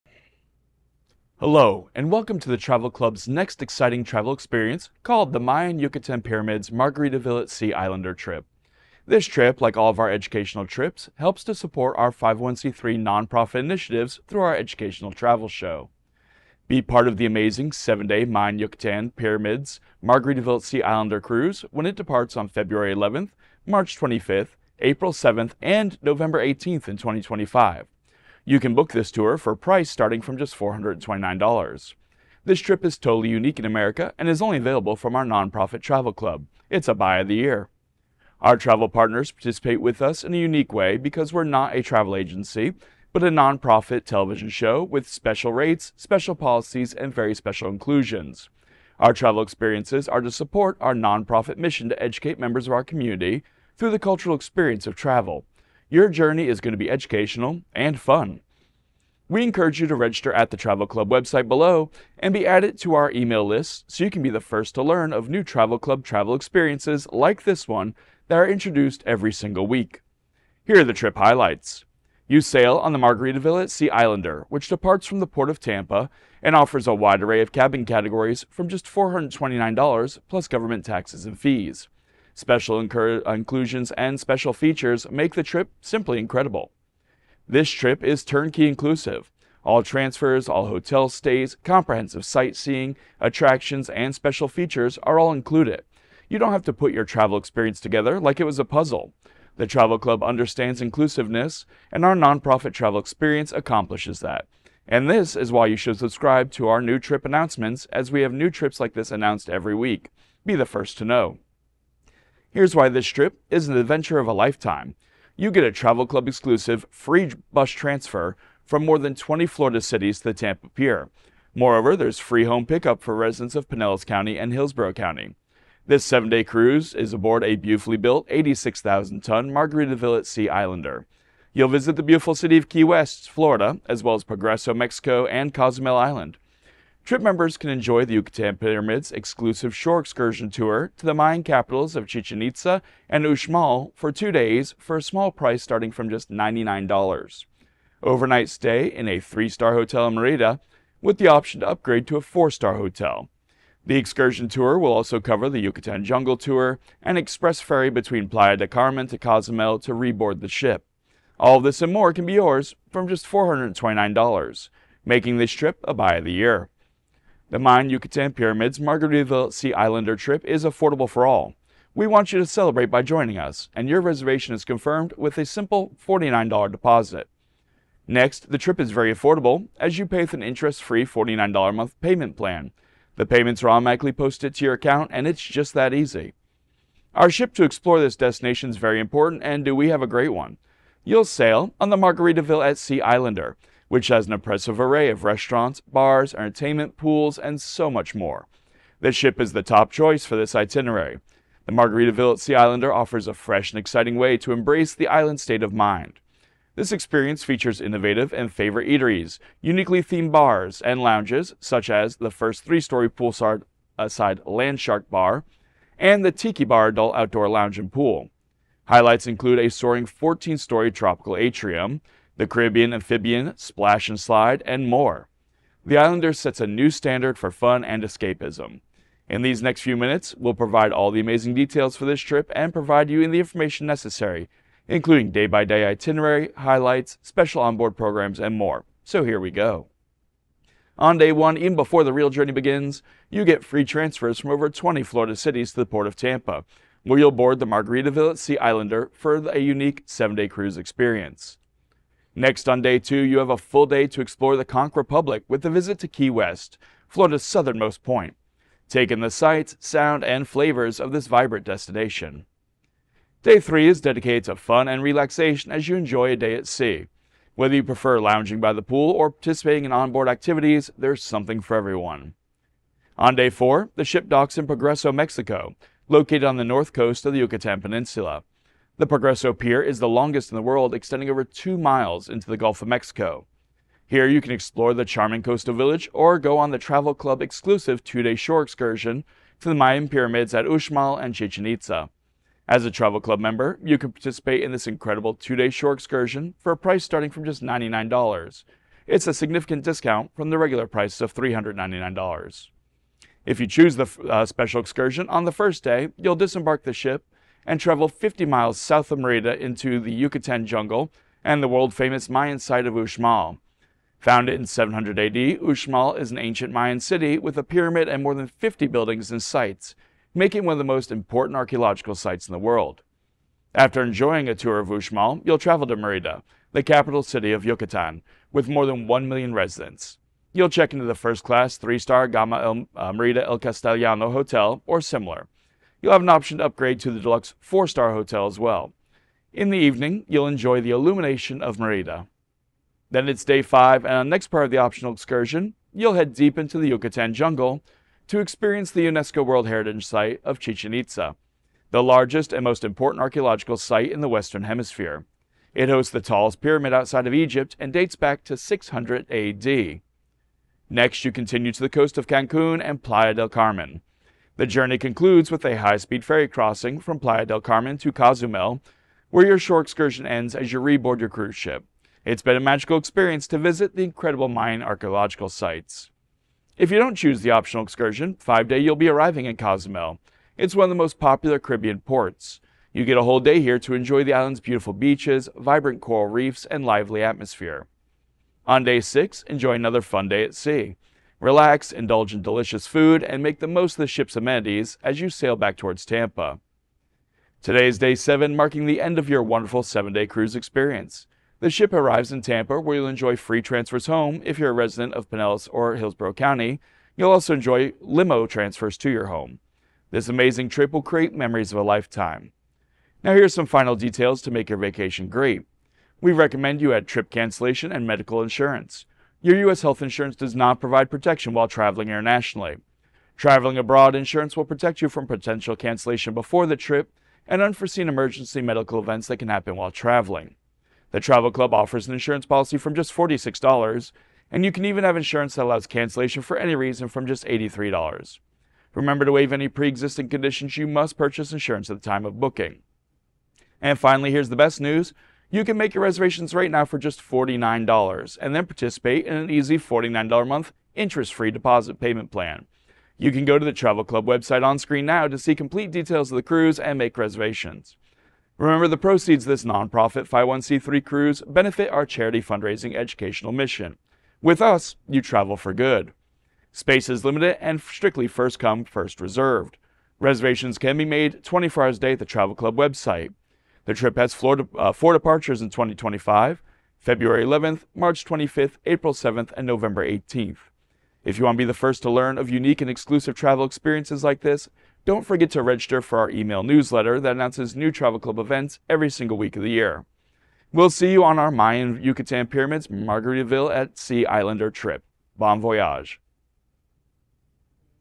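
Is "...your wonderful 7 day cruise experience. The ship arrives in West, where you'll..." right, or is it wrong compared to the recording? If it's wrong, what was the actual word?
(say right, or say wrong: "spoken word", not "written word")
wrong: "Tampa", not "West".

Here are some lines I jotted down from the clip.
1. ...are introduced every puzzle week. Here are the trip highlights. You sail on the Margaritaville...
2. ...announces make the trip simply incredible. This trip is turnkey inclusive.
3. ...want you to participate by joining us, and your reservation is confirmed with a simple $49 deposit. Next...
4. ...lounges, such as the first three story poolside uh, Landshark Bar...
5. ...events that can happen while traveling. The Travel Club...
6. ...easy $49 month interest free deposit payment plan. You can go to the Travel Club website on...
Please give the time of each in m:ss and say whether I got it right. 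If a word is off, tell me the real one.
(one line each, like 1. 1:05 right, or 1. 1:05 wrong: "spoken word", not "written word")
1. 1:08 wrong: "single", not "puzzle"
2. 1:24 wrong: "features", not "announces"
3. 2:52 wrong: "celebrate", not "participate"
4. 3:31 right
5. 7:08 right
6. 7:29 right.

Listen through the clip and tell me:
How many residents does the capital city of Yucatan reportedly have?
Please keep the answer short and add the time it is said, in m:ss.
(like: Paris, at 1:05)
More than 1 million, at 5:28.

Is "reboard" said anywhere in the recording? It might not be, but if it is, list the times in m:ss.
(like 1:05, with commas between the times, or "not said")
2:39, 6:10.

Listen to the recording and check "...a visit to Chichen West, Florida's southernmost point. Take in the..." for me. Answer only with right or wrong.
wrong.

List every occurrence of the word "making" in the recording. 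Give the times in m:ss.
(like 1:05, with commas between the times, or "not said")
2:45, 5:20.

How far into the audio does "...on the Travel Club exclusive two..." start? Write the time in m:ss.
4:46.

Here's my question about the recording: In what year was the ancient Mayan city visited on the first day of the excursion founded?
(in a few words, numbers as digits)
700 AD.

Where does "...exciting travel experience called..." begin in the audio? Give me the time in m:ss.
0:03.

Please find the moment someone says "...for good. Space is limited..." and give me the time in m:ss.
7:45.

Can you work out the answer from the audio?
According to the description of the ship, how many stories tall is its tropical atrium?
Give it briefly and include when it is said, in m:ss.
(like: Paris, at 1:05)
14, at 3:40.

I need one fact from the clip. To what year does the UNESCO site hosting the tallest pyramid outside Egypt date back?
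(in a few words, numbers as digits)
600 AD.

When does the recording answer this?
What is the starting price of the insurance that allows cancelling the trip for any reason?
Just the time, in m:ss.
7:17.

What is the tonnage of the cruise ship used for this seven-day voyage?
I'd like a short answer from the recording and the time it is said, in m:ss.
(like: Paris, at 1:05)
86,000 tons, at 2:08.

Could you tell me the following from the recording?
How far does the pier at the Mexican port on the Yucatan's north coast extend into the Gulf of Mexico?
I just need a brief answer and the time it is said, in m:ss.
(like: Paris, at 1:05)
Over two miles, at 4:41.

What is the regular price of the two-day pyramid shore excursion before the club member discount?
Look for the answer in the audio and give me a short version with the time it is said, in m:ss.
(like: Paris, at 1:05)
$399, at 5:01.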